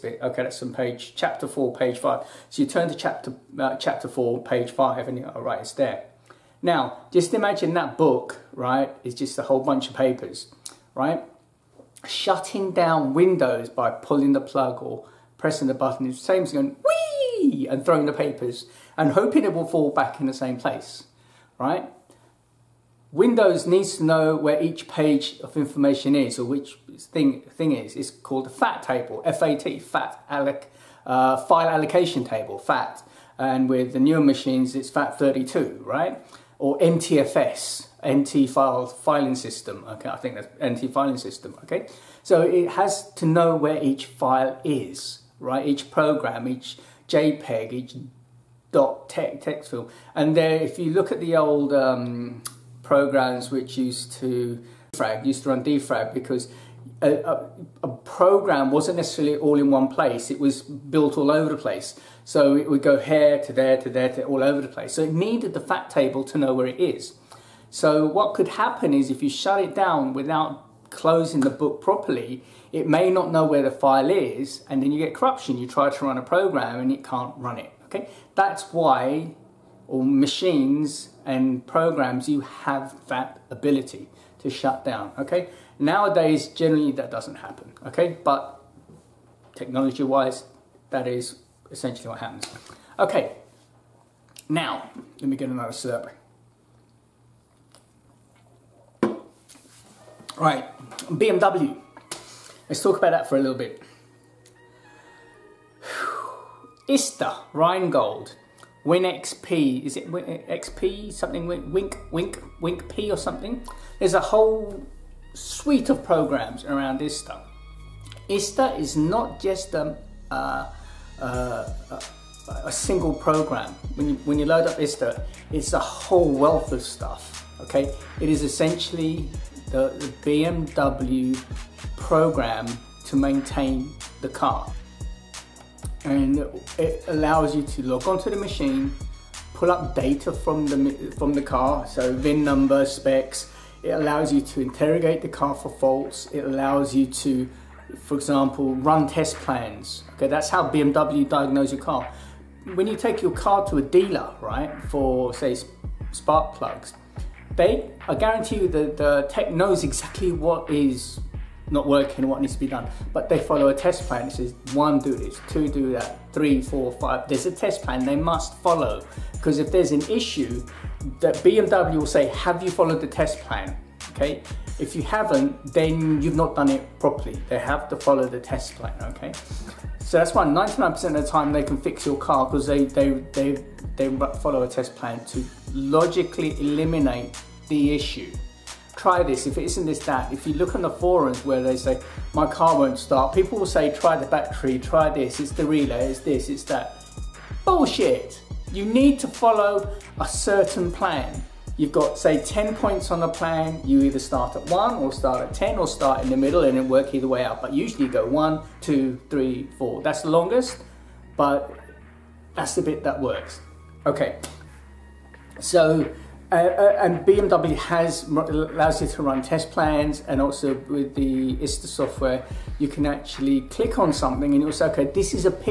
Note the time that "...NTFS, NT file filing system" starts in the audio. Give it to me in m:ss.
0:36.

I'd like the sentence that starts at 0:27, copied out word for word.
It's called a FAT table, F-A-T, FAT, alloc, uh, file allocation table, FAT.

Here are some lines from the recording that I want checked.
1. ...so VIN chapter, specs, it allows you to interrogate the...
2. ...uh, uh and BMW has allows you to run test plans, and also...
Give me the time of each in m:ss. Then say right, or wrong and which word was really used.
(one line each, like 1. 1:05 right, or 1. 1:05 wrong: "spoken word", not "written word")
1. 2:21 wrong: "number", not "chapter"
2. 3:36 right.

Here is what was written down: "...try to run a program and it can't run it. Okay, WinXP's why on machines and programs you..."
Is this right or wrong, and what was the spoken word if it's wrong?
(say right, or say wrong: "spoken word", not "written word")
wrong: "That", not "WinXP".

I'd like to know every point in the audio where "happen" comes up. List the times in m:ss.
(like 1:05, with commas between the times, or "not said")
1:08, 1:27, 1:32.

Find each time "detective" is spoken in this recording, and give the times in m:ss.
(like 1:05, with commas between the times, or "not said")
not said.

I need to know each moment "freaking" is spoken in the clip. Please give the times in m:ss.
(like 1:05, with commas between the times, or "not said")
not said.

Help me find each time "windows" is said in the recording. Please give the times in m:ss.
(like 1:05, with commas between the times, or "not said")
0:13, 0:23.